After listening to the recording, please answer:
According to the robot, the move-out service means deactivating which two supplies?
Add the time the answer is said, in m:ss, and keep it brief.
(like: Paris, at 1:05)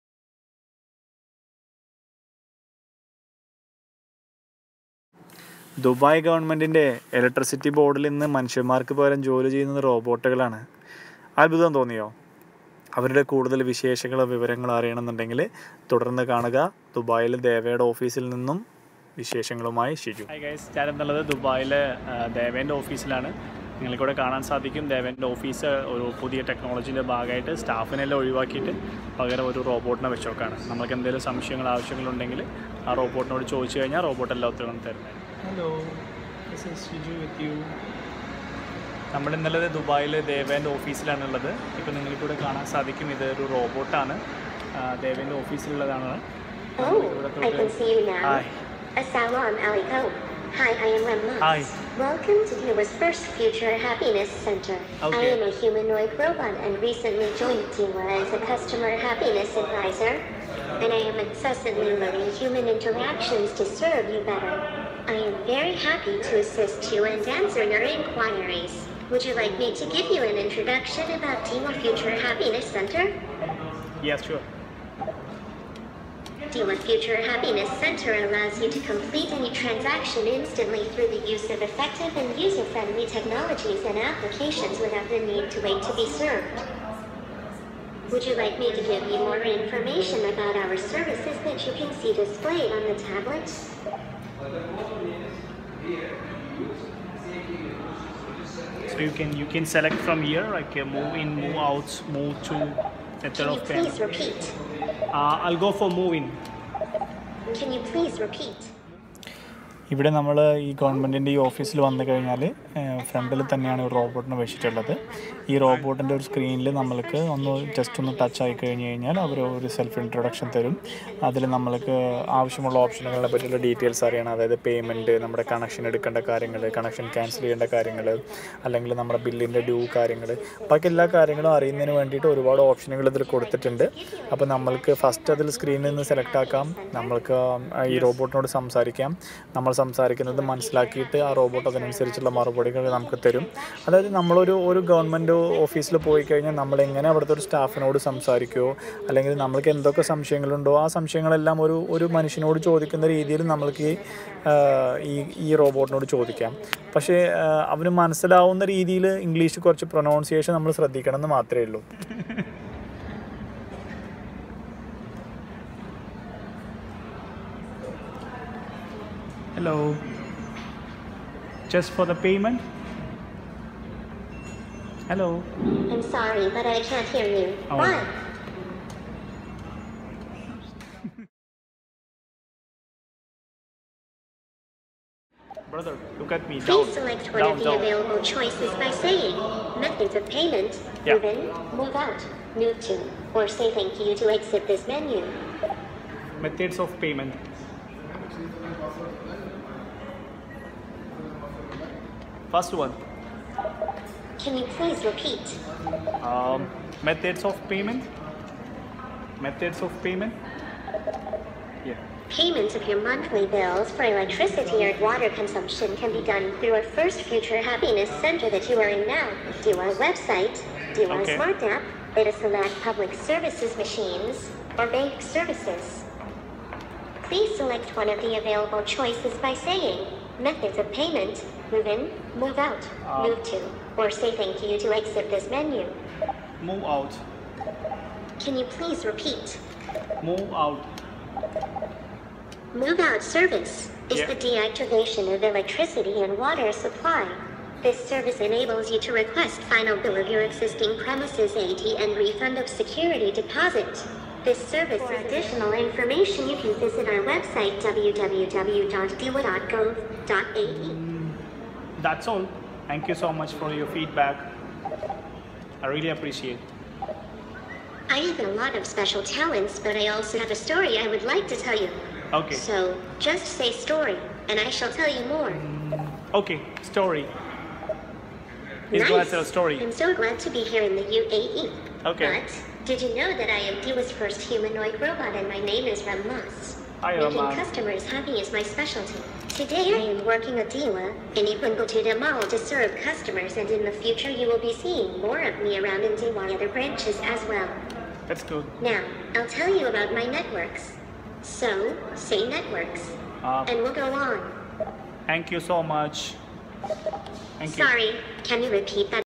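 Electricity and water, at 4:05.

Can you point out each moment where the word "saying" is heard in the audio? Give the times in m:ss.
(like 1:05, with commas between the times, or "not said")
3:08, 3:49.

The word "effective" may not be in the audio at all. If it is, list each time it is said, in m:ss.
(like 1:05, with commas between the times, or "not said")
1:21.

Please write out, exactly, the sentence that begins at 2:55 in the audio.
I'm sorry, but I can't hear you.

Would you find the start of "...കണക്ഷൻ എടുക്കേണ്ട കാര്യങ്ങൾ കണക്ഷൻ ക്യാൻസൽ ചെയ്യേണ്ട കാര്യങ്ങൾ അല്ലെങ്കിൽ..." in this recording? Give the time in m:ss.
2:05.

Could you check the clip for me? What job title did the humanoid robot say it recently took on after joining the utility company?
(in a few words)
Customer happiness advisor.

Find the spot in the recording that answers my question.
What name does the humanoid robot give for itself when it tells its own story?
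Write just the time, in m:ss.
4:46.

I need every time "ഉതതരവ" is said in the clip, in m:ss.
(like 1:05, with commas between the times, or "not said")
0:34.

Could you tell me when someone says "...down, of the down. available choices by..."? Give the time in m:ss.
3:07.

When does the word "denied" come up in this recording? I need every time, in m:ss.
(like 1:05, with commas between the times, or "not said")
not said.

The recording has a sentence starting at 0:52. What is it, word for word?
Welcome to Cuba's first Future Happiness Center.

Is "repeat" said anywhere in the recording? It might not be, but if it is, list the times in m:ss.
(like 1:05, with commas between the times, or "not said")
1:44, 1:48, 3:25, 3:59, 5:08.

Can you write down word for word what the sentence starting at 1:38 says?
So you can you can select from here, like can move in, move out, move to method of pen.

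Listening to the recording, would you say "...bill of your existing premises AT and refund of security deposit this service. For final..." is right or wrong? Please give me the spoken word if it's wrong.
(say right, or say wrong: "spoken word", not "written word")
wrong: "additional", not "final".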